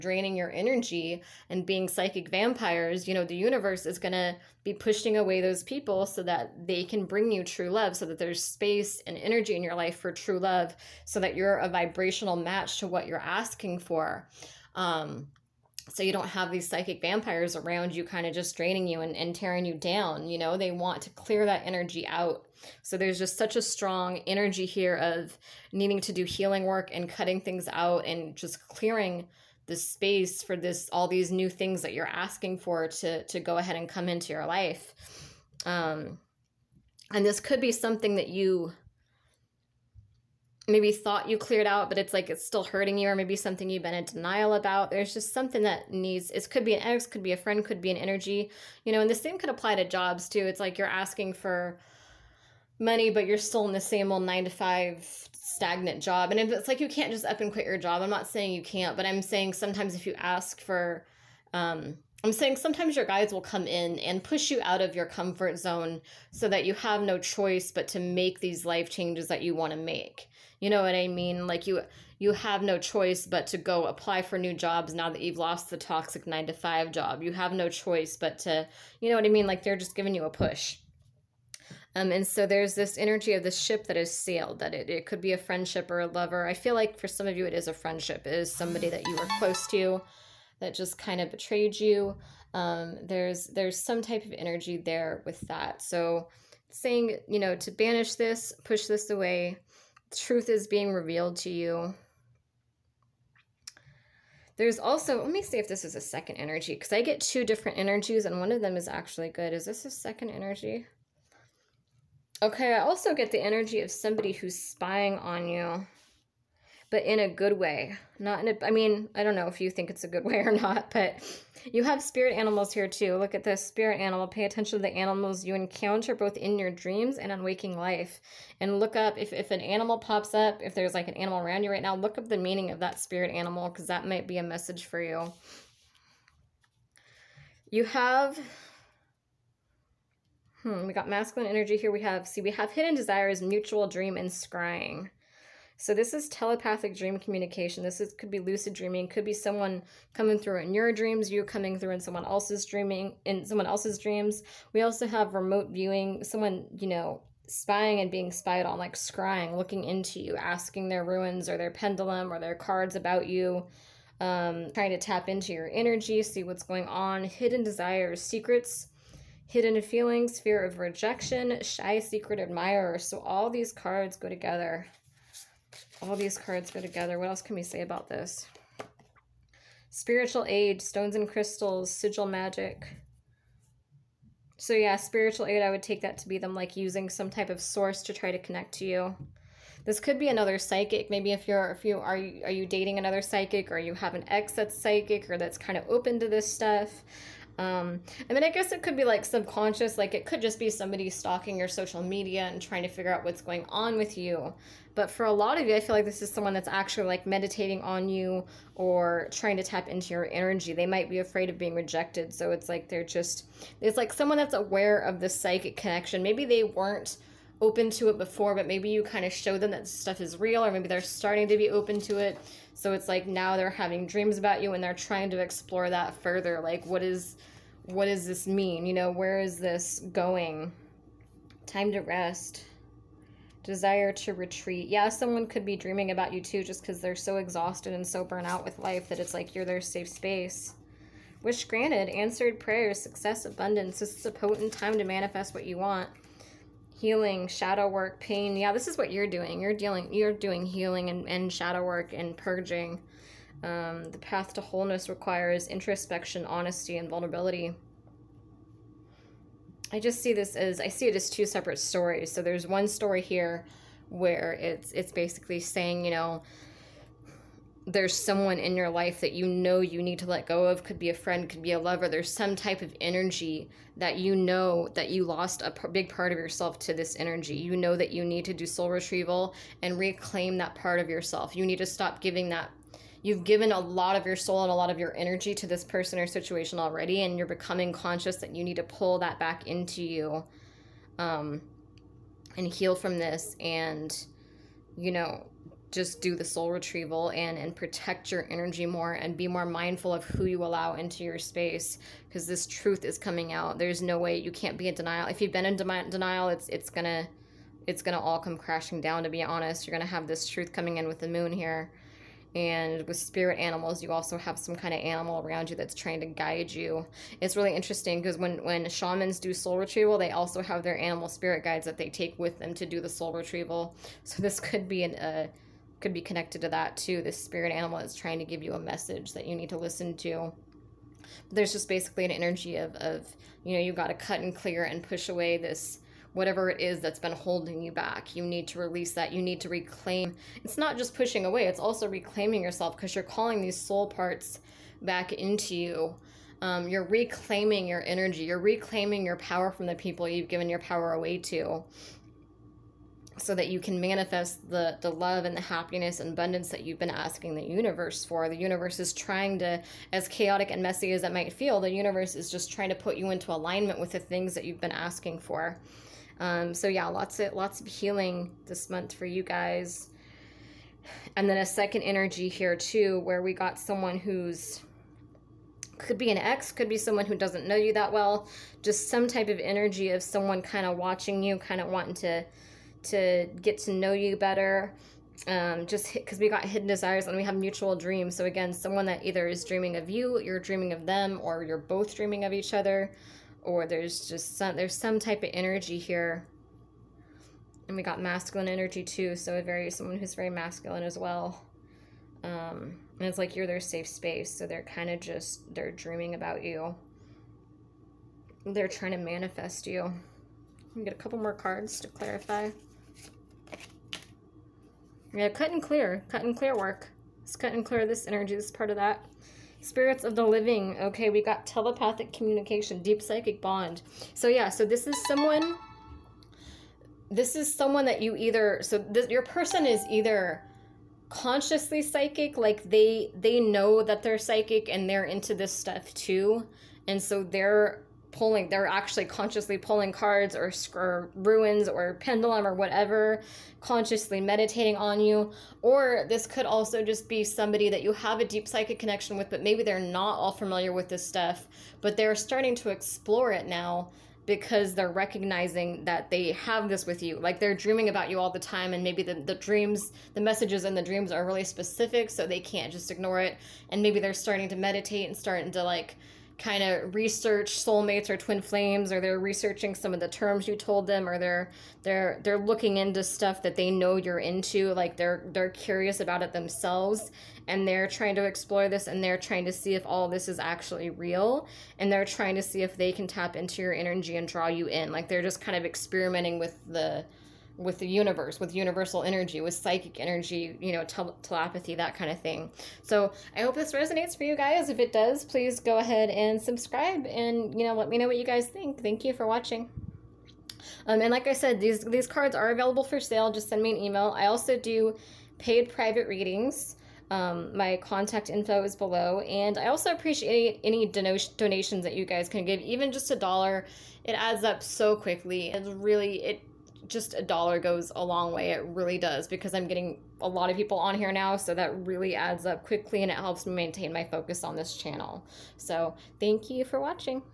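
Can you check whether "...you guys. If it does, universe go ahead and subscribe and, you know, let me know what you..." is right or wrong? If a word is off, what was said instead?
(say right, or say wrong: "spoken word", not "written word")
wrong: "please", not "universe".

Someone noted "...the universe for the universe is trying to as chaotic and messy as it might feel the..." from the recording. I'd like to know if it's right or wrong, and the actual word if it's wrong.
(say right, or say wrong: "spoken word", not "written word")
right.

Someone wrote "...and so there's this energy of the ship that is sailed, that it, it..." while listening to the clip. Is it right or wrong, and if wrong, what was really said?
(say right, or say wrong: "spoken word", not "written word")
right.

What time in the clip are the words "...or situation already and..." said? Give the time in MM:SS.
04:46.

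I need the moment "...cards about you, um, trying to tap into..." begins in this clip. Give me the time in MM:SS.
02:42.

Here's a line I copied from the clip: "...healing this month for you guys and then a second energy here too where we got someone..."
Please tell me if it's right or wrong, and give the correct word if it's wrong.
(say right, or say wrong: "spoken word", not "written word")
right.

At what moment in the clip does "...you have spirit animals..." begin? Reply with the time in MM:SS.
02:01.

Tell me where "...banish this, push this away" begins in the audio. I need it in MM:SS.
01:37.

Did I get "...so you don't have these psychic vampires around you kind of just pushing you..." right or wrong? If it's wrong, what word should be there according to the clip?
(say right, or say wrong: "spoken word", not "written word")
wrong: "draining", not "pushing".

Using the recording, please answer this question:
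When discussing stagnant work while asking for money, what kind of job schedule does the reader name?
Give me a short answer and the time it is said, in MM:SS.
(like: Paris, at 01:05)
nine to five, at 00:54.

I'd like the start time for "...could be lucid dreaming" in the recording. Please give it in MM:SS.
02:28.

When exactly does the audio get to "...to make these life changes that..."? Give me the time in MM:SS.
01:07.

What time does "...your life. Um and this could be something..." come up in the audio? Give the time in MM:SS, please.
00:34.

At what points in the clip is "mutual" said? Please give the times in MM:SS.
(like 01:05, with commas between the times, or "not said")
02:23, 06:27.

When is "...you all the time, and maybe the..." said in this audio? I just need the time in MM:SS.
07:38.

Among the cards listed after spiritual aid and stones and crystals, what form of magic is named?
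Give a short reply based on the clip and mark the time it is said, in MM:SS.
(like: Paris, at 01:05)
sigil magic, at 03:01.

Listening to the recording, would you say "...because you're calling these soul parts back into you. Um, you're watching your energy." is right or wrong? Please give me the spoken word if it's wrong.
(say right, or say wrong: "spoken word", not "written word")
wrong: "reclaiming", not "watching".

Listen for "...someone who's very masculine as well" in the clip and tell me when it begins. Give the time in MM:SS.
06:39.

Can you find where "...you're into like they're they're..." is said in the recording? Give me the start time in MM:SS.
07:54.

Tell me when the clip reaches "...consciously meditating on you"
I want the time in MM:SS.
07:23.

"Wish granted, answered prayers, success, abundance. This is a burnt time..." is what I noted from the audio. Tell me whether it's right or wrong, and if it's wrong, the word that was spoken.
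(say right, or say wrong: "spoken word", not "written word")
wrong: "potent", not "burnt".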